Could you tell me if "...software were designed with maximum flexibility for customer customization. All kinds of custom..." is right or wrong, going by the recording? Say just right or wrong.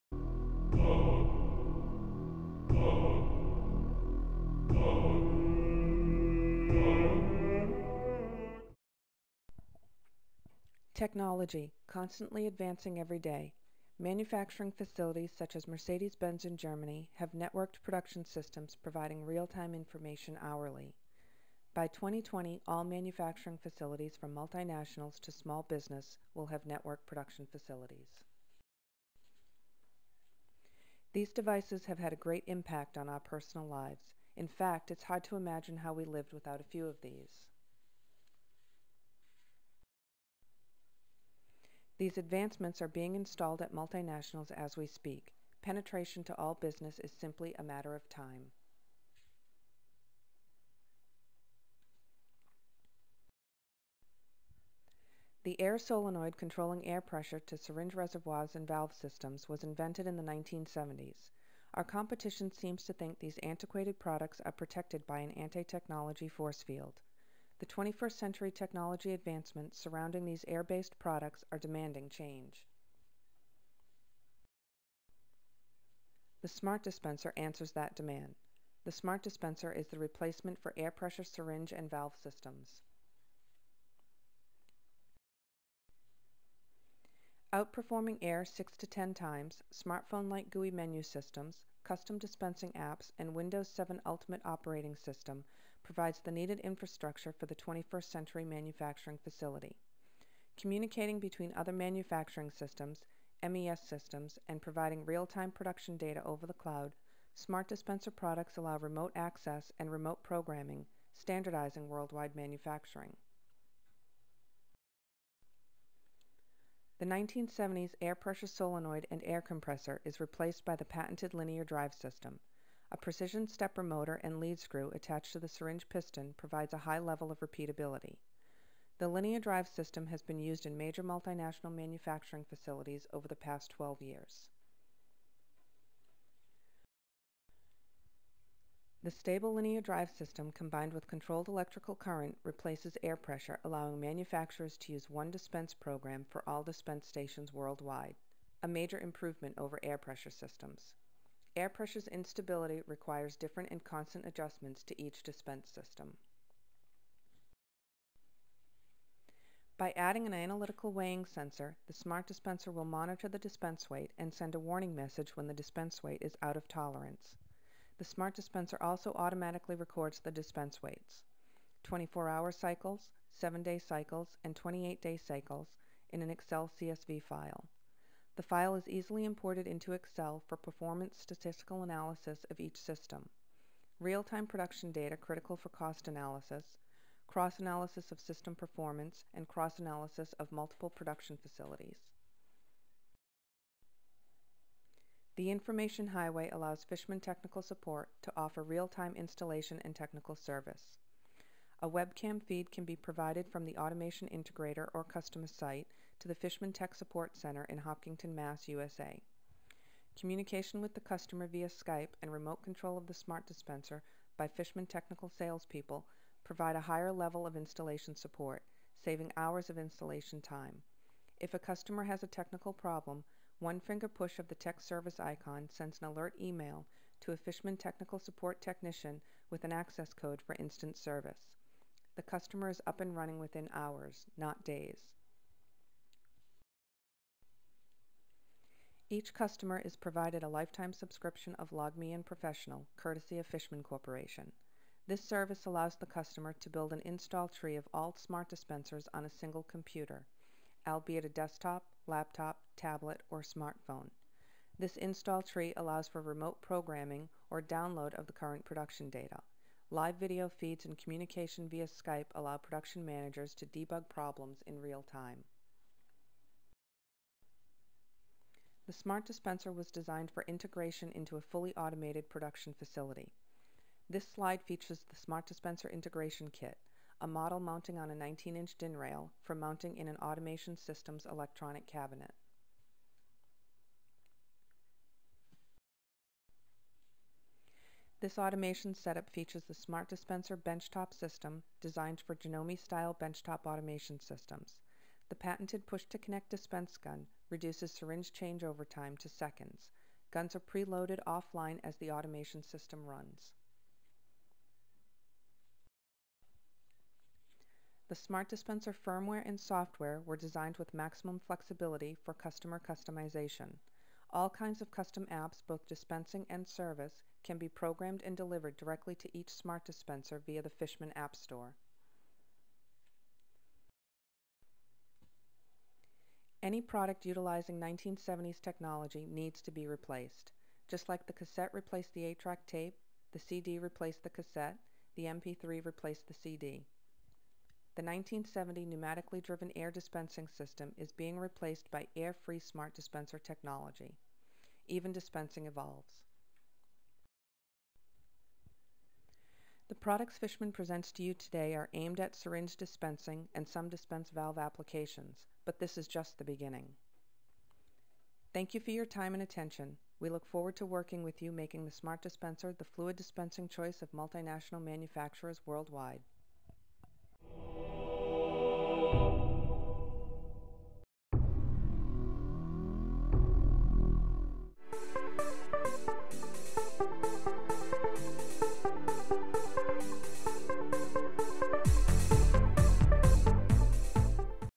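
right.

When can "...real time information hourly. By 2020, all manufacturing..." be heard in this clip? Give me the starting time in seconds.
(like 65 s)
19 s.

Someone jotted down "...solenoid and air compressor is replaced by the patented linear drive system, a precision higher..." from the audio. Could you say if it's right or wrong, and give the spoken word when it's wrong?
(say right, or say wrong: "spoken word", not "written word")
wrong: "stepper", not "higher".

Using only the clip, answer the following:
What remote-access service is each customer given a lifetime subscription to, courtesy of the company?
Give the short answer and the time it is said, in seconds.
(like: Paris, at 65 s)
LogMeIn Professional, at 241 s.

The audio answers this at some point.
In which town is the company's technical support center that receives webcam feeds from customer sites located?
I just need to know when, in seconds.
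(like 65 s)
207 s.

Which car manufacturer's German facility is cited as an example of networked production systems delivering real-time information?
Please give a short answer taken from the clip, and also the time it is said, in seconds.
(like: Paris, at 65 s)
Mercedes Benz, at 15 s.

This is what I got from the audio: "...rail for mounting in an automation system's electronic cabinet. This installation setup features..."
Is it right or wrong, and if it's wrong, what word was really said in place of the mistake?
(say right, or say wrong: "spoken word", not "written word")
wrong: "automation", not "installation".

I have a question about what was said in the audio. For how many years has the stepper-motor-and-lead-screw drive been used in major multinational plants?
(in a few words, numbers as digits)
12.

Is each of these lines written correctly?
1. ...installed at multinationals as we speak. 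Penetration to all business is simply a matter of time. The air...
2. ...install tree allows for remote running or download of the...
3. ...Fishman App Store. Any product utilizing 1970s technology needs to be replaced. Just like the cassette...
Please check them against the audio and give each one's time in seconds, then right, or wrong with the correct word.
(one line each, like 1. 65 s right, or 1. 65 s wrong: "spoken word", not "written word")
1. 43 s right
2. 254 s wrong: "programming", not "running"
3. 320 s right.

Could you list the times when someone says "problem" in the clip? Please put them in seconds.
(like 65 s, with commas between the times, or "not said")
222 s, 264 s.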